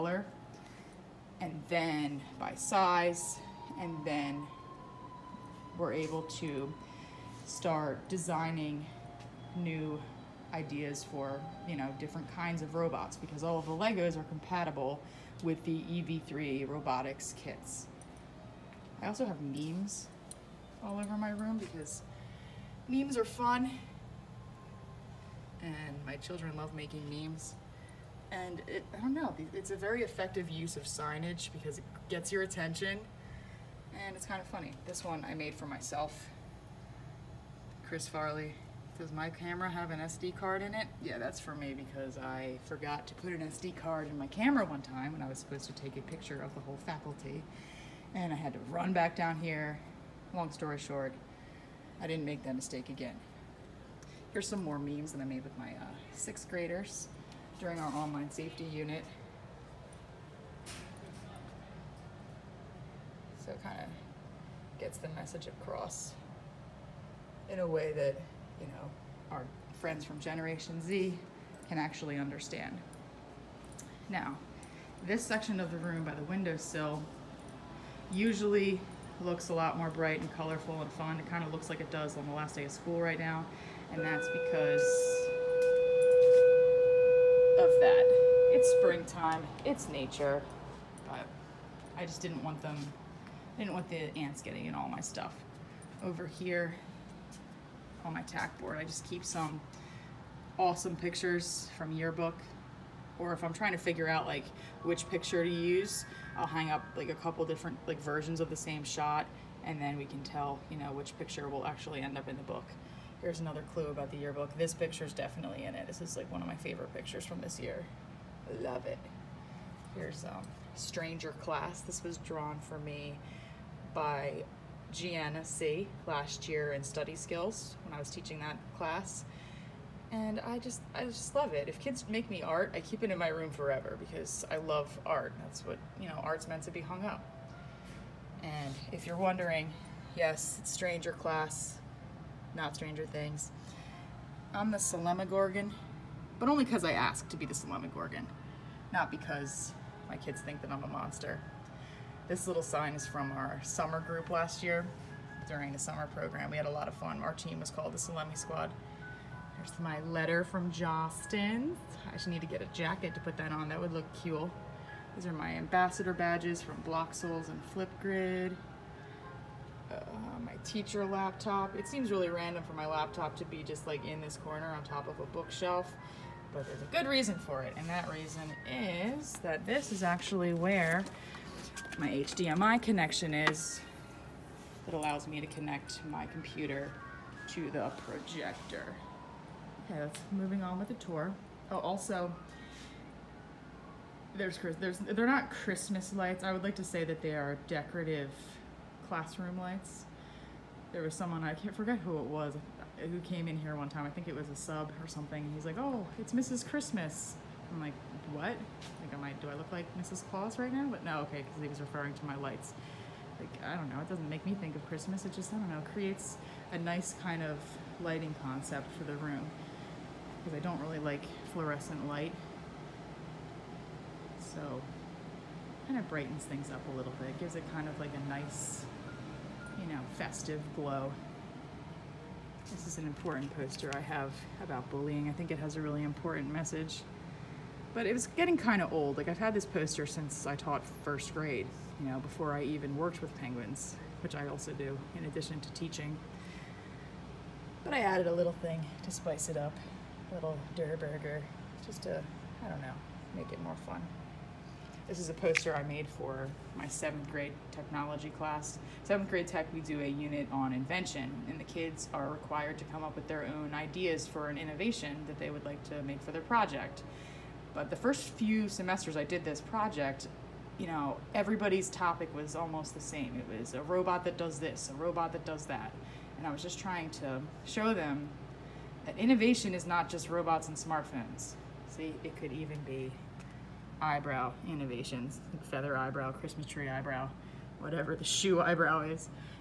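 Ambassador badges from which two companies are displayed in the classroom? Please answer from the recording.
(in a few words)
Bloxels and Flipgrid.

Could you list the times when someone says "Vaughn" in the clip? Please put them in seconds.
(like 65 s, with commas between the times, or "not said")
not said.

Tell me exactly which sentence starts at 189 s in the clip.
Okay, let's moving on with the tour.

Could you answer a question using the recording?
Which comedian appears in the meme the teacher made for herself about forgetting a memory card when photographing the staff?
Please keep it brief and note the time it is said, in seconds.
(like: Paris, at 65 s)
Chris Farley, at 37 s.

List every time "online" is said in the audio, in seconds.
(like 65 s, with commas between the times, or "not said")
57 s.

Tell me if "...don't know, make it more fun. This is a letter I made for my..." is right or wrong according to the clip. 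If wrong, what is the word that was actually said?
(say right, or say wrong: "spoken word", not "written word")
wrong: "poster", not "letter".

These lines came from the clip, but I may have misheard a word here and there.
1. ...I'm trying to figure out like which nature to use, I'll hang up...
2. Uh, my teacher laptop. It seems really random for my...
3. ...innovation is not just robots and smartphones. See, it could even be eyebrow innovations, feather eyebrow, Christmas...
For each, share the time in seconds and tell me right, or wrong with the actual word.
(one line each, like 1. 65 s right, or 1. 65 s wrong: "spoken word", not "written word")
1. 103 s wrong: "picture", not "nature"
2. 169 s right
3. 279 s right.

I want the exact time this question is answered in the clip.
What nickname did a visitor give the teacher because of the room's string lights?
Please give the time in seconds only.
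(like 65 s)
206 s.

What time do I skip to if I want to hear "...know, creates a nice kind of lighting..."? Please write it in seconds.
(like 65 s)
215 s.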